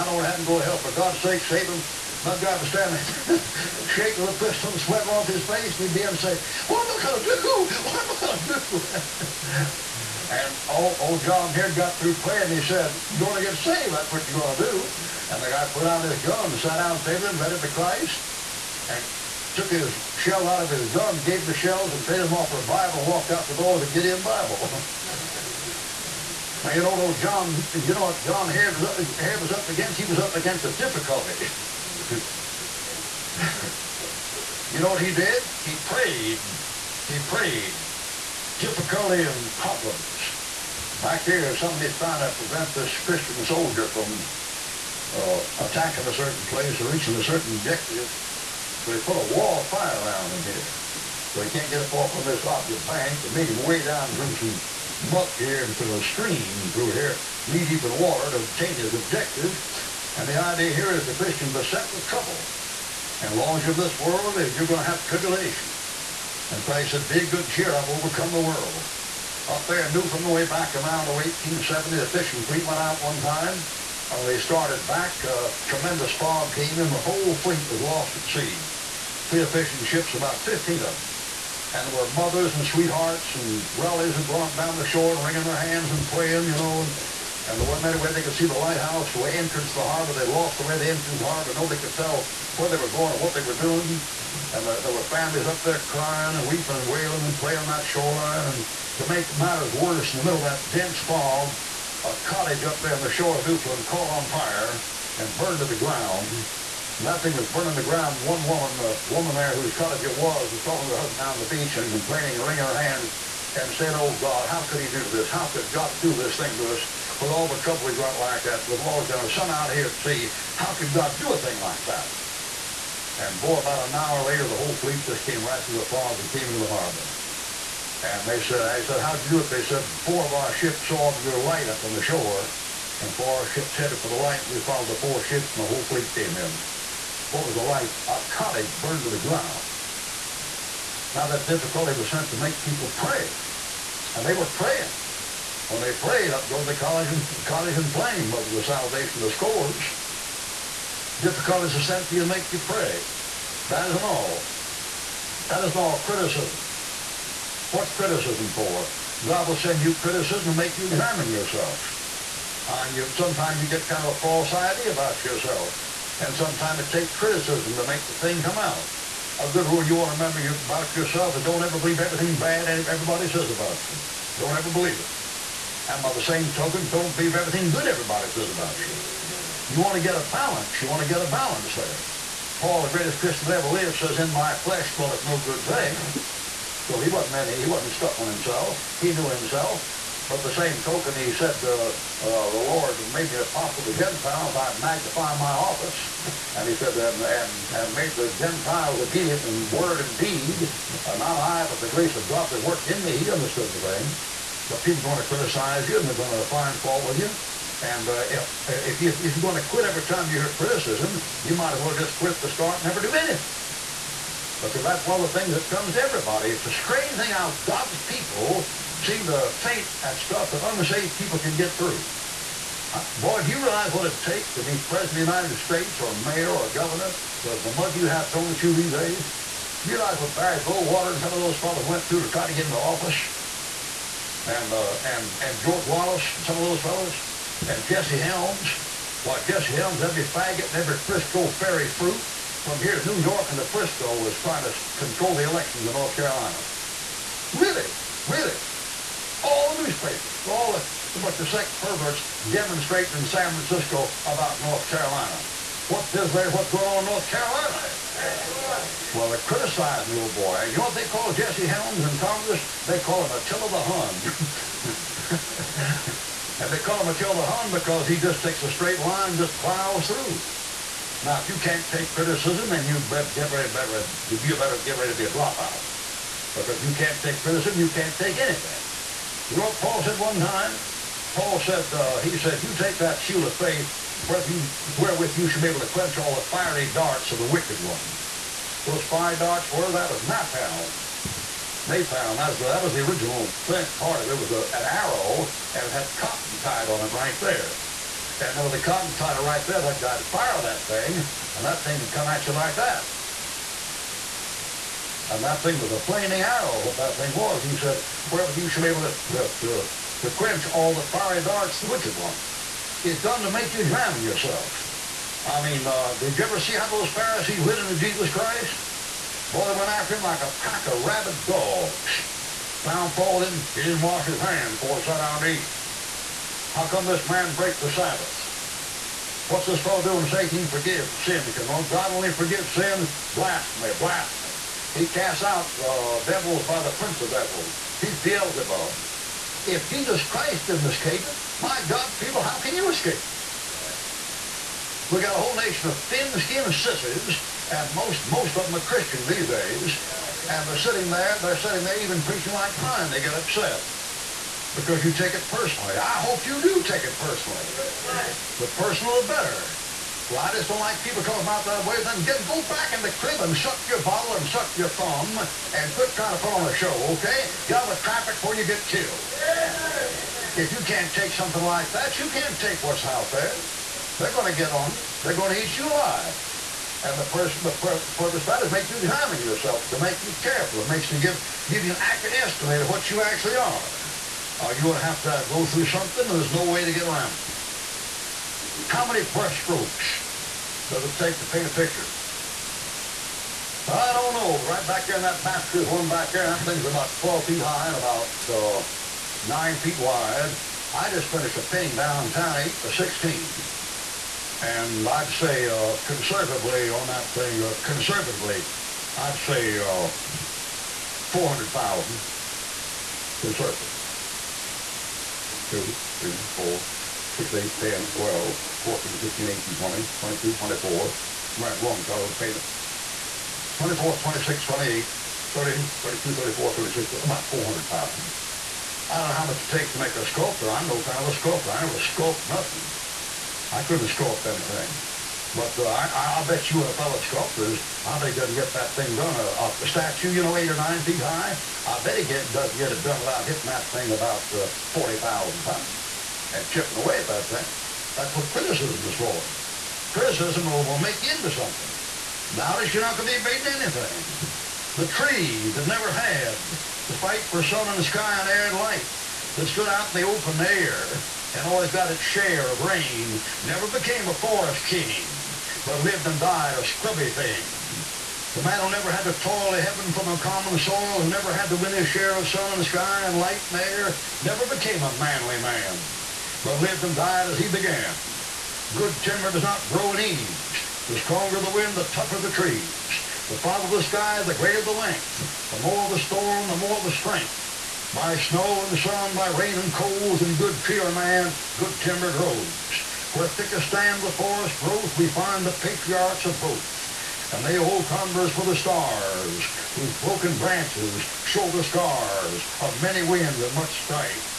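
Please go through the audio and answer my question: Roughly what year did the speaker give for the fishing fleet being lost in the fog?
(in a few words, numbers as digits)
1870.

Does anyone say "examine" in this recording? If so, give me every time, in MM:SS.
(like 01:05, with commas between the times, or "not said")
02:40, 05:13, 06:18.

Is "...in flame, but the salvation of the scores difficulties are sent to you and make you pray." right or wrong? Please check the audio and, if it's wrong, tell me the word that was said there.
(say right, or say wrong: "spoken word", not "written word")
right.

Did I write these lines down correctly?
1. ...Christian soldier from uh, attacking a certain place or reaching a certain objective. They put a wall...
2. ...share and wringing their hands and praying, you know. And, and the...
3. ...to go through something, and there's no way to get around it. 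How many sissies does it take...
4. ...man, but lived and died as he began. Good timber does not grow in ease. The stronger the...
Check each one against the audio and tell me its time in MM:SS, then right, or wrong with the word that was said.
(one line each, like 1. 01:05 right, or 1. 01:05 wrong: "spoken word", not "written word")
1. 00:42 right
2. 01:24 wrong: "shore", not "share"
3. 06:25 wrong: "brushstrokes", not "sissies"
4. 07:55 right.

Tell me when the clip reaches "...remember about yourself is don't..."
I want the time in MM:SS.
02:50.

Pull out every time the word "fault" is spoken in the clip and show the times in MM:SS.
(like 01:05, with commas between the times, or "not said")
03:26, 05:23.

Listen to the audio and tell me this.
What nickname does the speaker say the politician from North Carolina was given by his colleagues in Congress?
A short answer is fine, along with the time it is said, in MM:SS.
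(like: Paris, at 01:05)
Attila the Hun, at 04:23.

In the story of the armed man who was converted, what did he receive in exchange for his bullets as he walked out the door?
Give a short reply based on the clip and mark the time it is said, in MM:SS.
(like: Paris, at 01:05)
Gideon Bible, at 00:23.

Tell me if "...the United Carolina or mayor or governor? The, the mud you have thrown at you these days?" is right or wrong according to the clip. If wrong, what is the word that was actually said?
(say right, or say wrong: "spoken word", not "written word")
wrong: "States", not "Carolina".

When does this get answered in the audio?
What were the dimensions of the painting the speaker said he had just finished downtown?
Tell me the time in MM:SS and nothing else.
06:42.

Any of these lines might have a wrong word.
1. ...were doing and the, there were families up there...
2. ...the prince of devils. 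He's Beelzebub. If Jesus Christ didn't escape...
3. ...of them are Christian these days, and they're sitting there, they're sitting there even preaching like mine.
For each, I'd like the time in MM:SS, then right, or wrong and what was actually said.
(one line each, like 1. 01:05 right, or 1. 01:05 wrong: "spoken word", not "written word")
1. 01:33 right
2. 05:36 right
3. 05:48 right.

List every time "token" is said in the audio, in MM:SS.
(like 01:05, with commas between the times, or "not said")
02:56, 03:10.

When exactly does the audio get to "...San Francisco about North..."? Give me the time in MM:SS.
04:13.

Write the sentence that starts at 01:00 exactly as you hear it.
And the idea here is the Christian beset with trouble.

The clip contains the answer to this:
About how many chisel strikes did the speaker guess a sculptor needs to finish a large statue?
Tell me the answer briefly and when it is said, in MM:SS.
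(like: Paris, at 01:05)
40,000, at 07:24.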